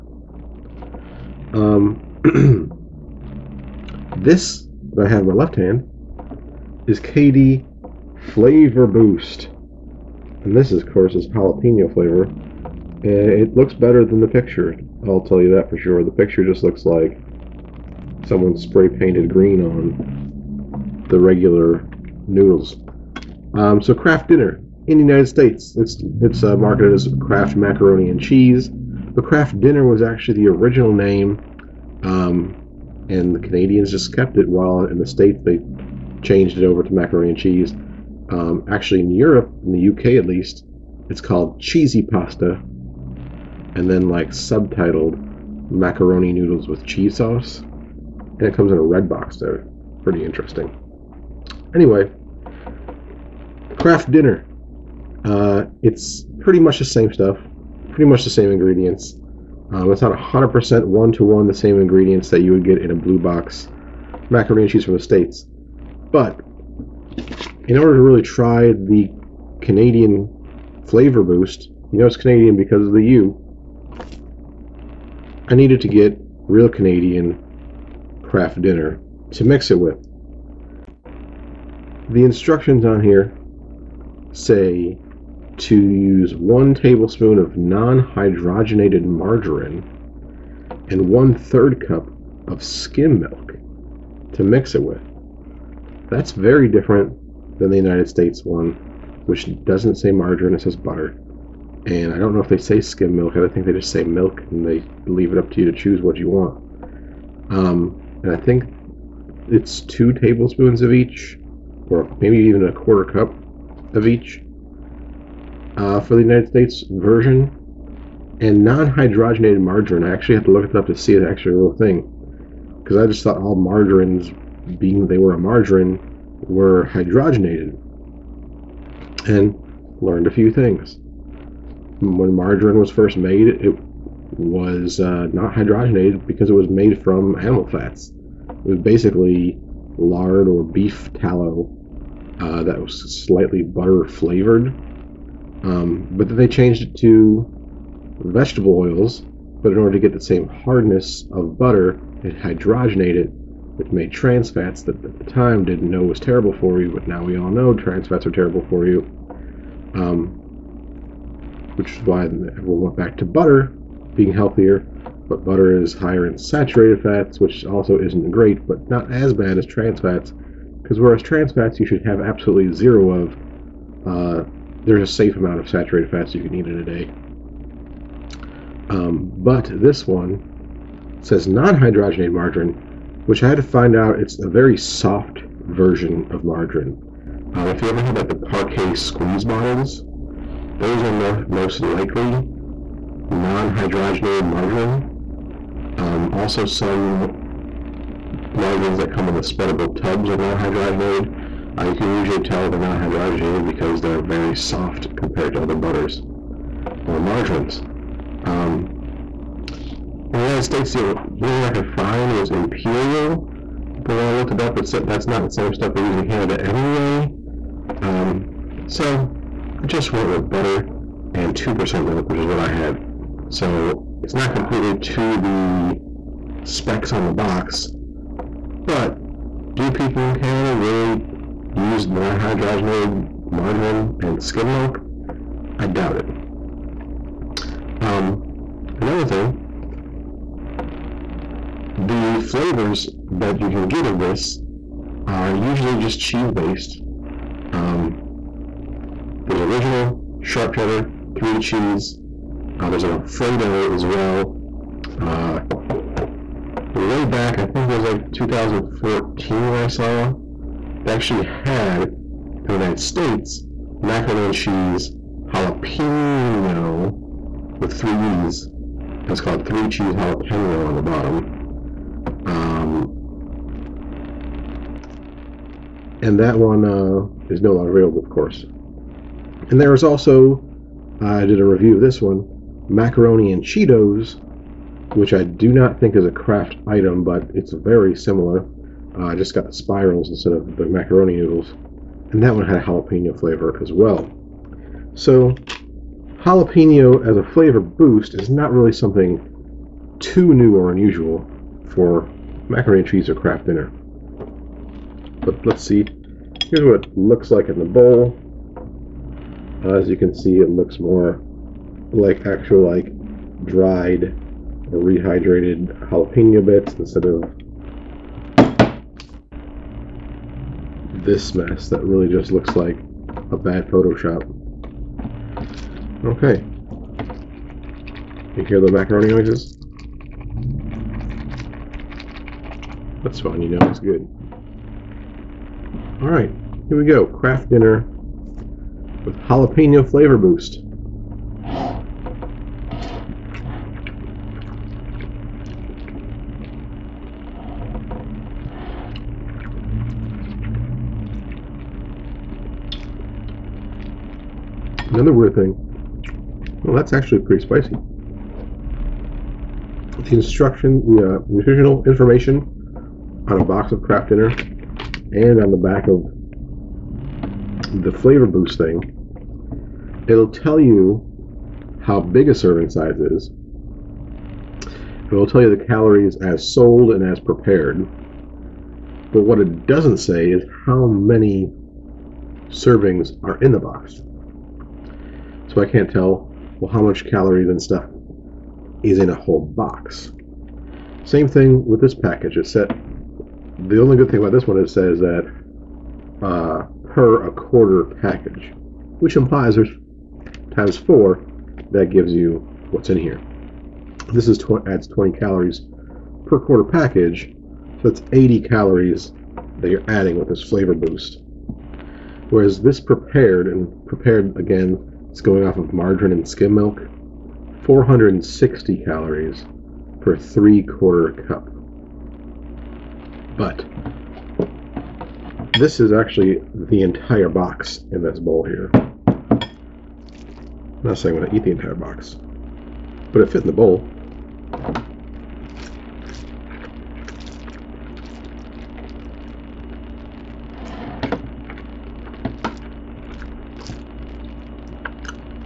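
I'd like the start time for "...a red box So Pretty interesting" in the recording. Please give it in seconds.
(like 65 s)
48 s.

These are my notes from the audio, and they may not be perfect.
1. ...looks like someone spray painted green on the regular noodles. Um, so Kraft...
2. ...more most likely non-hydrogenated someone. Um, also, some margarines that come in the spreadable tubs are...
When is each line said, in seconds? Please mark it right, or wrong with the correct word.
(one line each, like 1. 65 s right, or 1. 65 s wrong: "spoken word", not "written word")
1. 16 s right
2. 191 s wrong: "margarine", not "someone".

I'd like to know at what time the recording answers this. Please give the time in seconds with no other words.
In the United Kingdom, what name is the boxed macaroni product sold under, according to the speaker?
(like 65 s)
41 s.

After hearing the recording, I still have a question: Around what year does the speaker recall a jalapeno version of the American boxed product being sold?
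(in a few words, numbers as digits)
2014.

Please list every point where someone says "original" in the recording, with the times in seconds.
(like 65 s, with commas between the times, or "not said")
30 s, 249 s.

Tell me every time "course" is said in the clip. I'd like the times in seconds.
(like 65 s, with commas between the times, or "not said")
10 s, 278 s.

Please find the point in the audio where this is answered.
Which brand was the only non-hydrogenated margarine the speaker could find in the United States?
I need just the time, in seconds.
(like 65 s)
212 s.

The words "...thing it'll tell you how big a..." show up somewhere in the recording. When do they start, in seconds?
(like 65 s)
368 s.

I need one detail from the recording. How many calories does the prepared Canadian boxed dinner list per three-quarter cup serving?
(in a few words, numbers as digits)
460.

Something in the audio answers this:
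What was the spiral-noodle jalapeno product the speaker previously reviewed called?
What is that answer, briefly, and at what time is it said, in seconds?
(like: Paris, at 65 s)
macaroni and Cheetos, at 282 s.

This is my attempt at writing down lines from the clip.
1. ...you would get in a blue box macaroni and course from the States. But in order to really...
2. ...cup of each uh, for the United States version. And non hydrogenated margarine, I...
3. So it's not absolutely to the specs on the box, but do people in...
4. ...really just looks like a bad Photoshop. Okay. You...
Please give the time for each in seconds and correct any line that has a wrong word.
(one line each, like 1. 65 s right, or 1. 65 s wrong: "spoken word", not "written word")
1. 62 s wrong: "cheese", not "course"
2. 113 s right
3. 223 s wrong: "completely", not "absolutely"
4. 322 s right.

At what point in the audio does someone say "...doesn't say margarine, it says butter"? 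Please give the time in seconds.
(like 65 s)
99 s.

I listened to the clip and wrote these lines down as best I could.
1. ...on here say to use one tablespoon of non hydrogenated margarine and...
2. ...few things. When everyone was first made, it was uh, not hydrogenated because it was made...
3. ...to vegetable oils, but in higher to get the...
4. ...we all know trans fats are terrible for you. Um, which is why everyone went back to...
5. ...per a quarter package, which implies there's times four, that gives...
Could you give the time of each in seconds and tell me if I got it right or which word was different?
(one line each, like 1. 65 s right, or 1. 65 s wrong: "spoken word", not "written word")
1. 82 s right
2. 130 s wrong: "margarine", not "everyone"
3. 146 s wrong: "order", not "higher"
4. 157 s right
5. 397 s right.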